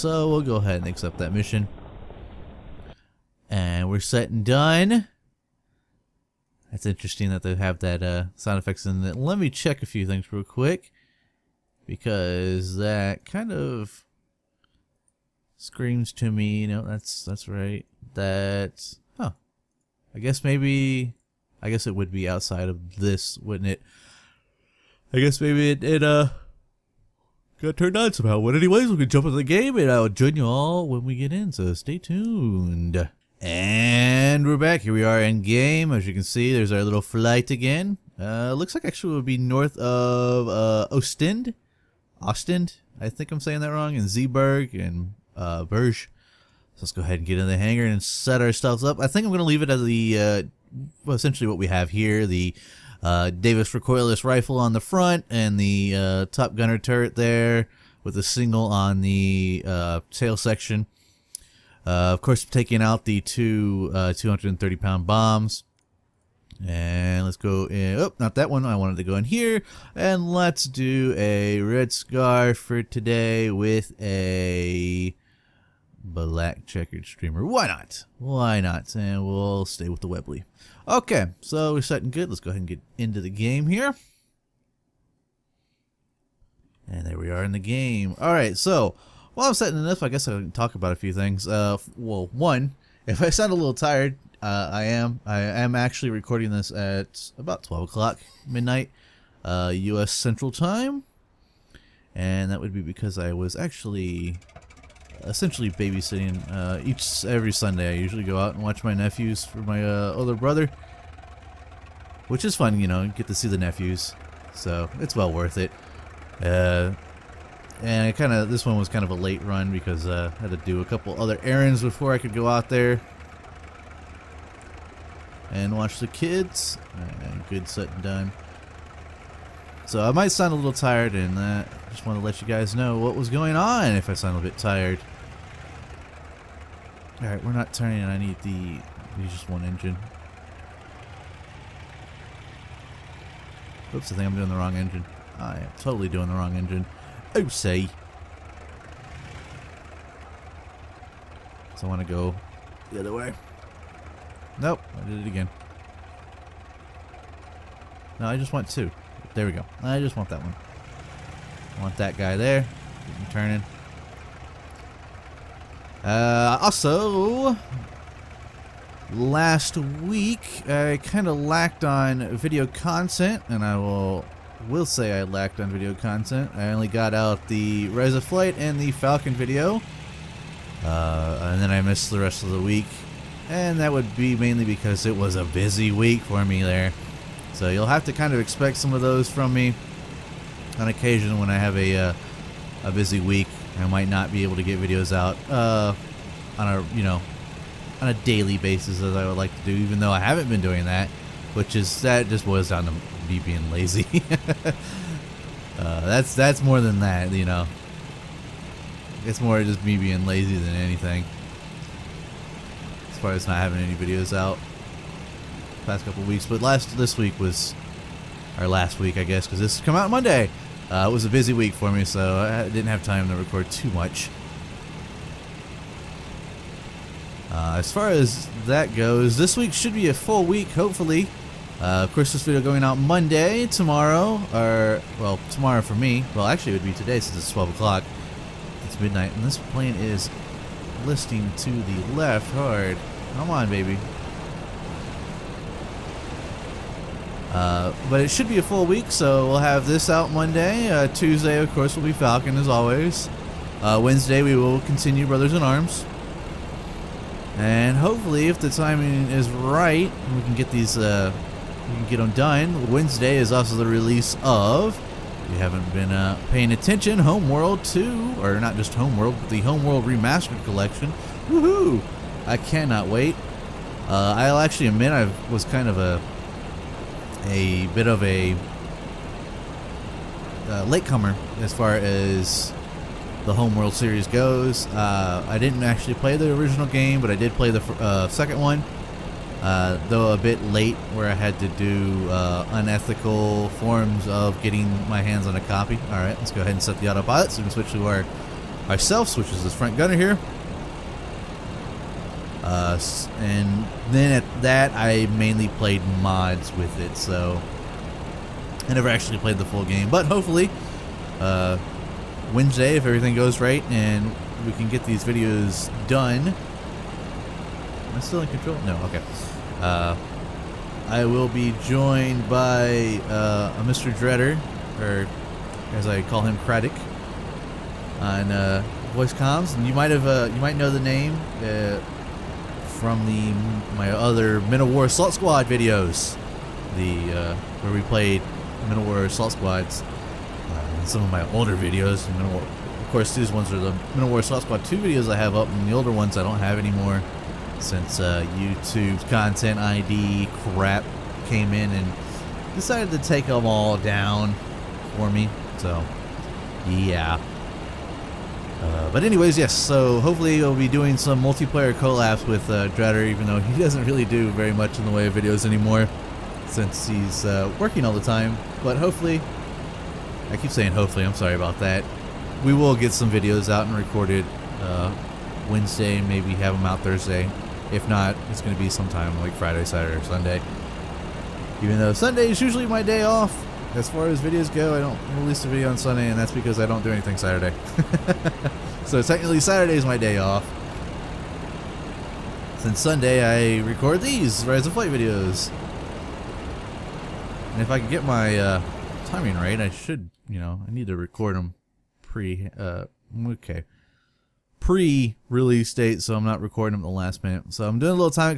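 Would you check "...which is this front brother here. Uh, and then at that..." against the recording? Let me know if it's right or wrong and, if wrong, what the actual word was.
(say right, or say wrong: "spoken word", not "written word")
wrong: "gunner", not "brother".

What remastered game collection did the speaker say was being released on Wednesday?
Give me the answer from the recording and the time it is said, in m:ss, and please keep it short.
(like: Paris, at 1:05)
Homeworld Remastered Collection, at 4:29.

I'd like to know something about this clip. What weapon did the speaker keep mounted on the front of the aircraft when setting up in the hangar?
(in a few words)
Davis recoilless rifle.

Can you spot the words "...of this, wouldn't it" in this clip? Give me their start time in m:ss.
0:22.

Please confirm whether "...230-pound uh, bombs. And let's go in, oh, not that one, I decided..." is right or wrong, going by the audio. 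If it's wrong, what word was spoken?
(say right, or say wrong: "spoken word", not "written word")
wrong: "wanted", not "decided".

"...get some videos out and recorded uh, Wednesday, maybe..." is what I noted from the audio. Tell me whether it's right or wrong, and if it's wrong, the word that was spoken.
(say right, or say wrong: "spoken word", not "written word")
right.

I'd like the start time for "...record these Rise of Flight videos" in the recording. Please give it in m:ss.
6:33.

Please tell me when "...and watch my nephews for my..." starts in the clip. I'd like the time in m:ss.
1:48.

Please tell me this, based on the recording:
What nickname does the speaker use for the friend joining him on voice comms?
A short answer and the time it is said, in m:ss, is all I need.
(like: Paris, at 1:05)
Craddock, at 5:26.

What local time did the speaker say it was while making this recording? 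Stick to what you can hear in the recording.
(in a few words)
12 o'clock midnight.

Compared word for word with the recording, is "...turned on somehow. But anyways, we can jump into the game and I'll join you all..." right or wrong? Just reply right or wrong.
right.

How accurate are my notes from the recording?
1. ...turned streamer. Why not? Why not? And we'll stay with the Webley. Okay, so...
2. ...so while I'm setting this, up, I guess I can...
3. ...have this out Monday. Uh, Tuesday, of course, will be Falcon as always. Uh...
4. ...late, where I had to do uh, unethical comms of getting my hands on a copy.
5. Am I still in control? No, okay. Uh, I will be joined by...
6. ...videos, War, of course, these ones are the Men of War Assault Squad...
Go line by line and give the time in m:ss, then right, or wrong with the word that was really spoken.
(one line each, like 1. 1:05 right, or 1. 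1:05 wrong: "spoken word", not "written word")
1. 1:16 wrong: "checkered", not "turned"
2. 1:28 right
3. 4:09 right
4. 4:50 wrong: "forms", not "comms"
5. 5:16 right
6. 5:41 right.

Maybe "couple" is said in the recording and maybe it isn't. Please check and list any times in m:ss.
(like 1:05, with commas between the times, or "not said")
2:00, 3:36.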